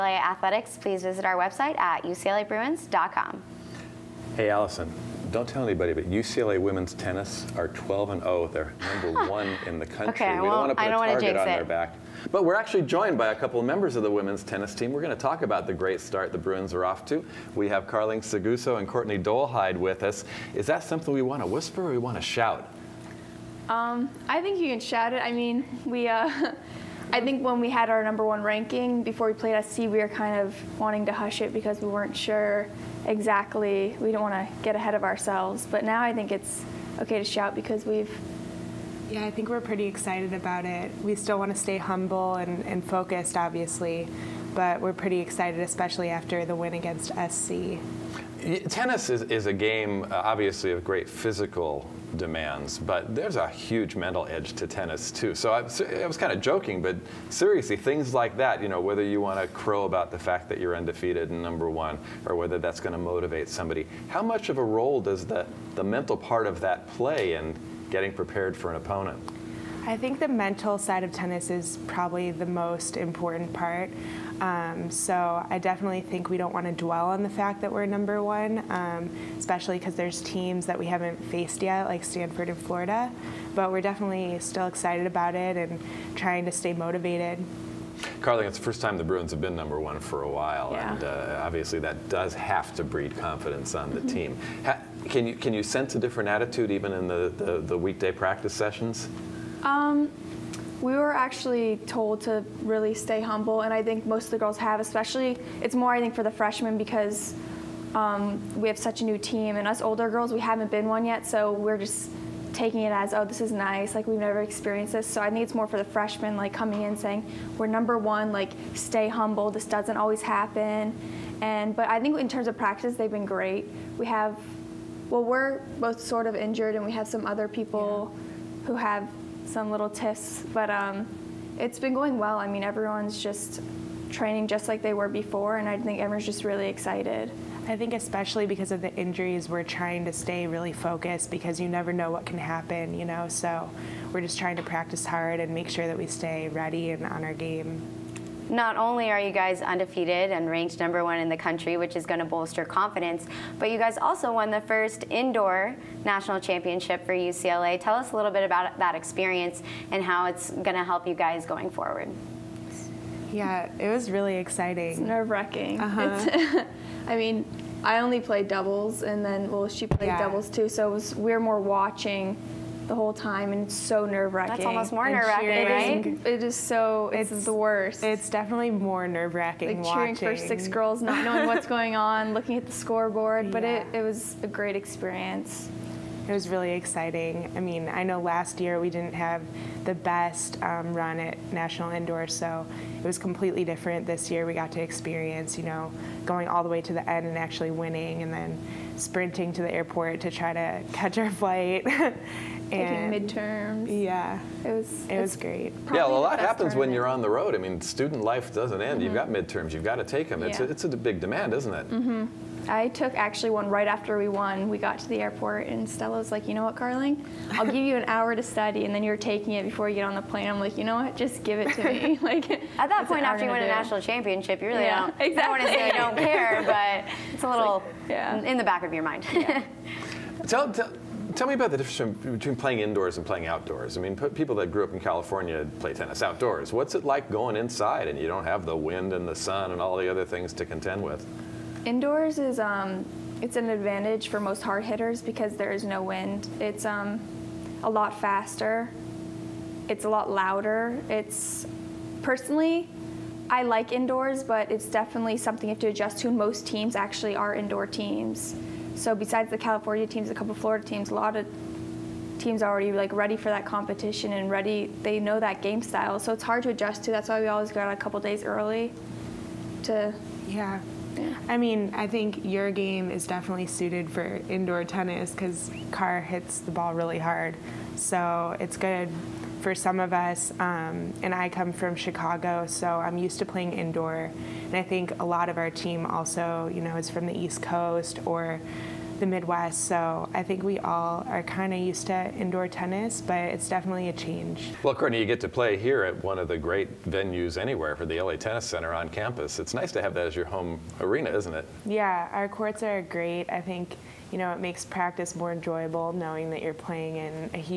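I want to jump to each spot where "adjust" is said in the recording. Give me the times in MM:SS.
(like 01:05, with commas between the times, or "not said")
04:15, 04:26.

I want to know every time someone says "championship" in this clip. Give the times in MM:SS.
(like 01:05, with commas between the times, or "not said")
02:36, 03:44.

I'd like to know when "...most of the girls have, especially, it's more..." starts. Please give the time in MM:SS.
01:44.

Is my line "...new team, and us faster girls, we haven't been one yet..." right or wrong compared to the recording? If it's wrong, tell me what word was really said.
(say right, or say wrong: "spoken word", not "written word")
wrong: "older", not "faster".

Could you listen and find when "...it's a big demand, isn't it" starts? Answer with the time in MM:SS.
03:30.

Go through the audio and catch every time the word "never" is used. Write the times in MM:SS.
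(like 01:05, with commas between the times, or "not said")
01:54, 02:21.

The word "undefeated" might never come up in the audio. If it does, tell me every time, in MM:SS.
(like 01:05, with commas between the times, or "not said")
01:00, 02:29.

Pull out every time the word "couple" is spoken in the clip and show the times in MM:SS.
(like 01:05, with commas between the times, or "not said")
00:13, 04:20, 04:27.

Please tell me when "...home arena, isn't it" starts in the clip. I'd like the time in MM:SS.
05:00.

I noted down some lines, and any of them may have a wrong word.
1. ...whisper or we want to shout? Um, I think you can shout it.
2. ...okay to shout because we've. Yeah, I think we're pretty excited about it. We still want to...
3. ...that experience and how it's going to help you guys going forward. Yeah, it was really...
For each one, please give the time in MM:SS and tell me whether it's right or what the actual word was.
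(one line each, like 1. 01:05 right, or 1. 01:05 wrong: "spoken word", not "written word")
1. 00:21 right
2. 00:36 right
3. 02:38 right.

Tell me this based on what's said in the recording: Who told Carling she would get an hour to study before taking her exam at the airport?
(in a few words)
Stella.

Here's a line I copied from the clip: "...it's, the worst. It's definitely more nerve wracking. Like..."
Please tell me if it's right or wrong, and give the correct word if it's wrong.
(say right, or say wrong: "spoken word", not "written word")
right.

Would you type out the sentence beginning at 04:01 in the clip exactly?
Indoors is um, it's an advantage for most hard hitters because there is no wind.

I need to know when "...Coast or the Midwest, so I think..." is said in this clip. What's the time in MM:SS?
04:47.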